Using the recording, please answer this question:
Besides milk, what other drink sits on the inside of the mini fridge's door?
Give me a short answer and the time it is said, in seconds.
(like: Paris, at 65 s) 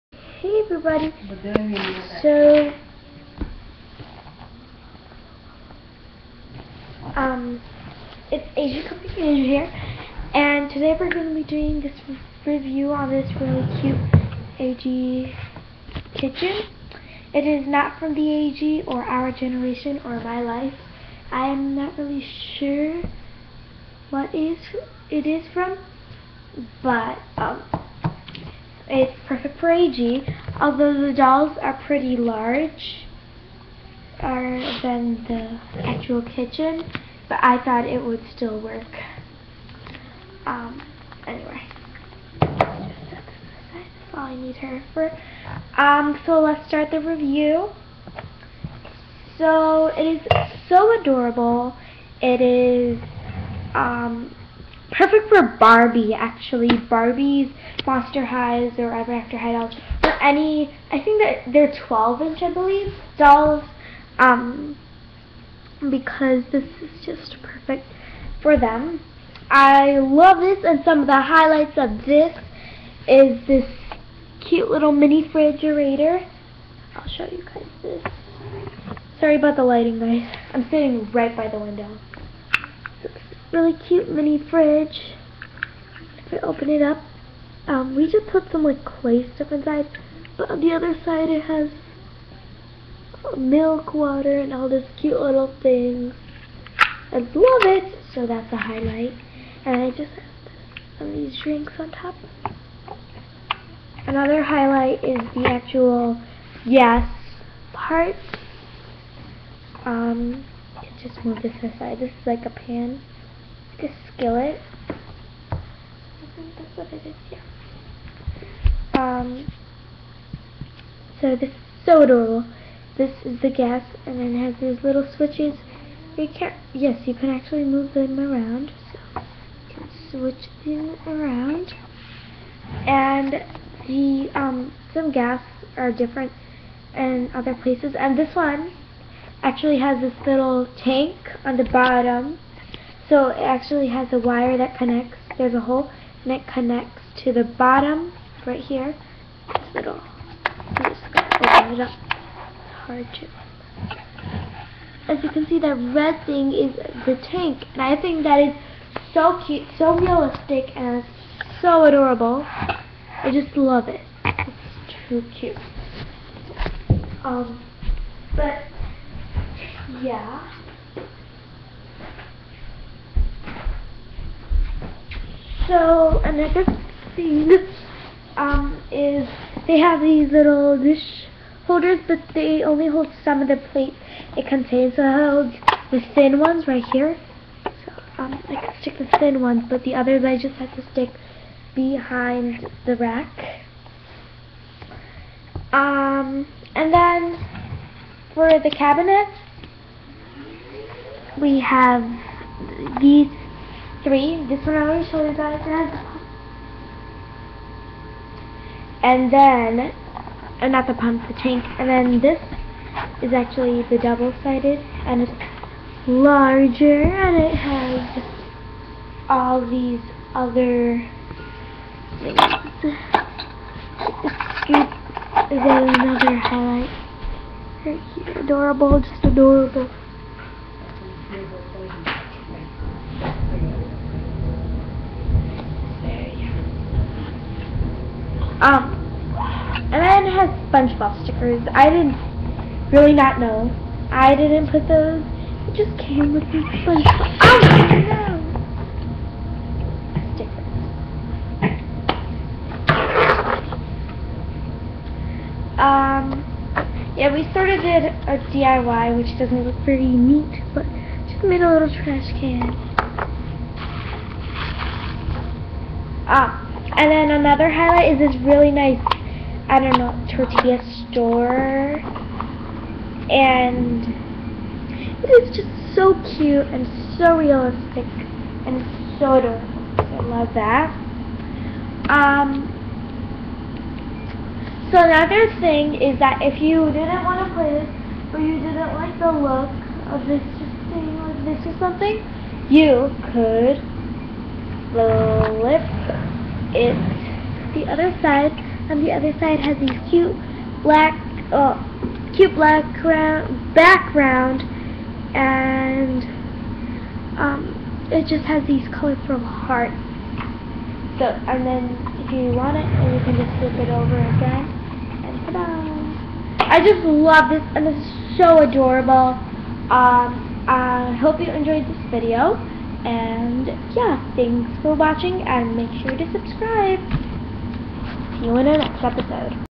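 water, at 93 s.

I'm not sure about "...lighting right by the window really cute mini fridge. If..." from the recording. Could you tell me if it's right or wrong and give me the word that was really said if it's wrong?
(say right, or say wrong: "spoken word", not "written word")
wrong: "sitting", not "lighting".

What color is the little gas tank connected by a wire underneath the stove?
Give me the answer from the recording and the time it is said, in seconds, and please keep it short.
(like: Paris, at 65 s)
red, at 155 s.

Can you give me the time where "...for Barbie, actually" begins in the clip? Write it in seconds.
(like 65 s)
55 s.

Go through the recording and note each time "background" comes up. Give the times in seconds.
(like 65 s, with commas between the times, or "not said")
303 s.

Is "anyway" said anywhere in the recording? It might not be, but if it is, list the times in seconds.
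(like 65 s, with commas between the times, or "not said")
41 s.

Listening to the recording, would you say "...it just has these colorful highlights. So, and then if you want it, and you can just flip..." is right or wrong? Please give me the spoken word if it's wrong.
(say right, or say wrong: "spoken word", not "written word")
wrong: "hearts", not "highlights".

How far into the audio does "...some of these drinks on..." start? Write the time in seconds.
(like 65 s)
100 s.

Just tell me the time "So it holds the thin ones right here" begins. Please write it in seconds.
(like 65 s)
184 s.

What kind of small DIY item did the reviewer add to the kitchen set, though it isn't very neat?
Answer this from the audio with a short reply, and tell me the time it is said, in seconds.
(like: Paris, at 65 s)
trash can, at 261 s.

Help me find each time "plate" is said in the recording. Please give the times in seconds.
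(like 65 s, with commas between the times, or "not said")
183 s.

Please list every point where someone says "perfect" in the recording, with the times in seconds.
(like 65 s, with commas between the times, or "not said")
29 s, 54 s, 67 s.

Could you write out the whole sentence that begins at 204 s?
This one I already showed you guys.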